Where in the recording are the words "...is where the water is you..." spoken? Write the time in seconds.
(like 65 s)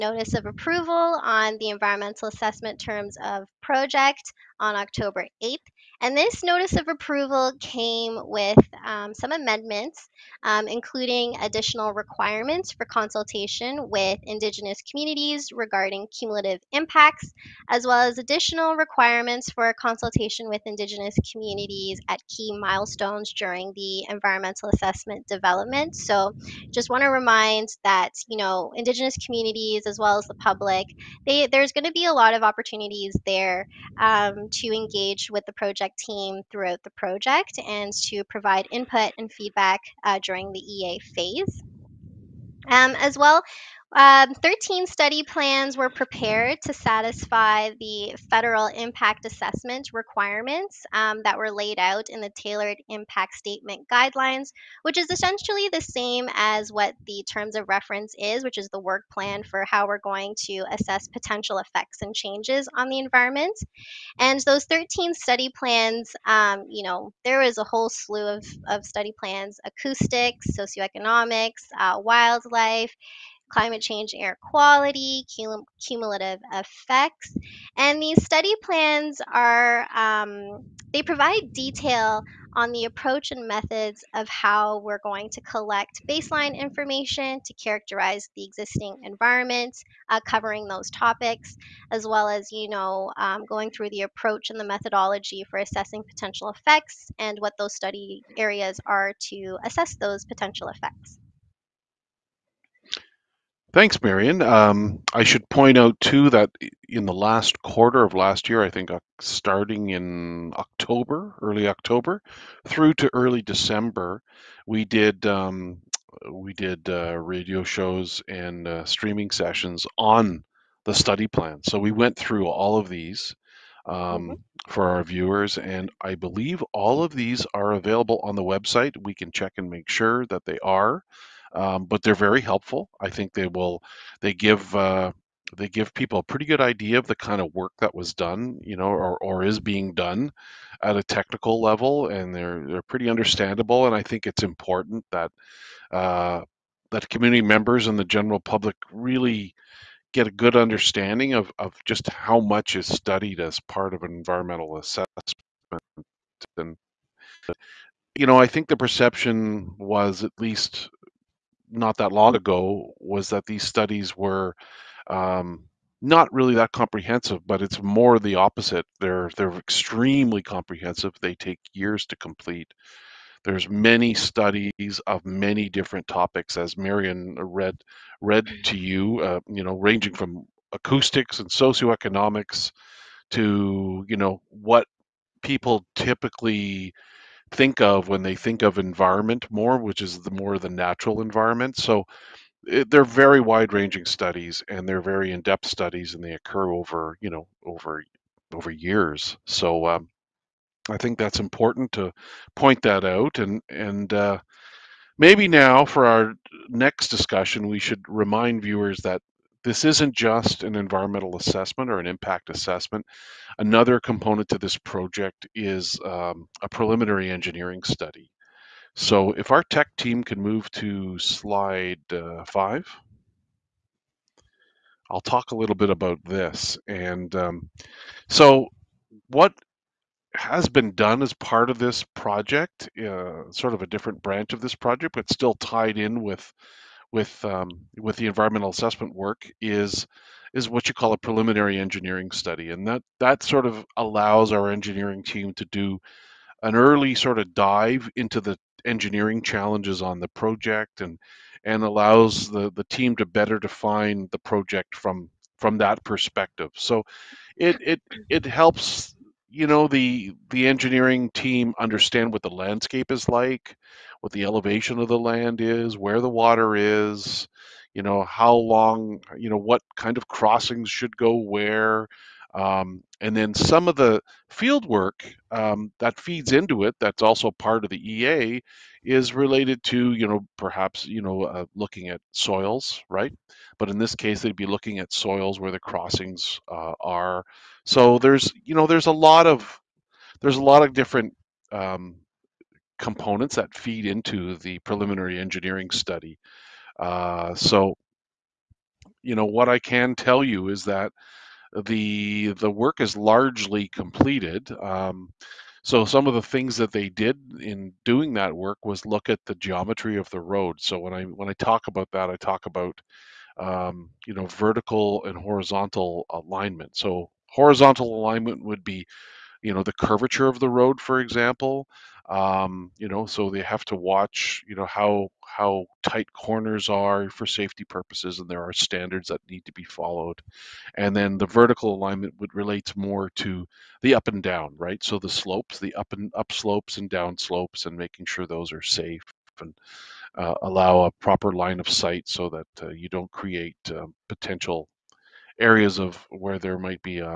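265 s.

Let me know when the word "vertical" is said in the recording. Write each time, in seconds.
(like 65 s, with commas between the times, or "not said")
314 s, 331 s.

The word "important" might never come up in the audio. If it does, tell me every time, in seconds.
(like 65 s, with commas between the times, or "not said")
144 s, 201 s.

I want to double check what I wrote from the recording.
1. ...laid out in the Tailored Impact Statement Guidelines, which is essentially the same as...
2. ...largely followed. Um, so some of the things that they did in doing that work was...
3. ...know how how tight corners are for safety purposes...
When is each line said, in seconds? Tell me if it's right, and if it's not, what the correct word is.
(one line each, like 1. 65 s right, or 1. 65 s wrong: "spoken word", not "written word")
1. 51 s right
2. 303 s wrong: "completed", not "followed"
3. 324 s right.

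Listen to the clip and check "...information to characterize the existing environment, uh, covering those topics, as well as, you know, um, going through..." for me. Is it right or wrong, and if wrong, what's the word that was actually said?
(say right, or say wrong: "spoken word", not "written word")
right.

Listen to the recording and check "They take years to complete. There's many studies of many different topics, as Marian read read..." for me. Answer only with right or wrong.
right.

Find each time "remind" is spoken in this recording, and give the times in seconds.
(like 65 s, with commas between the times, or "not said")
27 s, 208 s.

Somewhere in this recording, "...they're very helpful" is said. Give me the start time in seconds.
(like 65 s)
132 s.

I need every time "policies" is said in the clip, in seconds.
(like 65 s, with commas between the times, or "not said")
not said.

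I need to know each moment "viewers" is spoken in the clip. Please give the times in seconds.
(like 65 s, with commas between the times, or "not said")
125 s, 208 s.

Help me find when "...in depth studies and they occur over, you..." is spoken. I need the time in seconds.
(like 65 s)
195 s.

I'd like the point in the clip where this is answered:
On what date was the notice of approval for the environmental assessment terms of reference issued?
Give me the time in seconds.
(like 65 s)
4 s.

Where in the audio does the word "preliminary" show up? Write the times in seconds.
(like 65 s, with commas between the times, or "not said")
216 s, 241 s, 294 s.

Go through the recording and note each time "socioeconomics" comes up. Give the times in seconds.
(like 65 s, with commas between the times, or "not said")
70 s, 181 s.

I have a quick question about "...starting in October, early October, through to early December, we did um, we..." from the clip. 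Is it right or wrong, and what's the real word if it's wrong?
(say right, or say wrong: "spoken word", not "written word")
right.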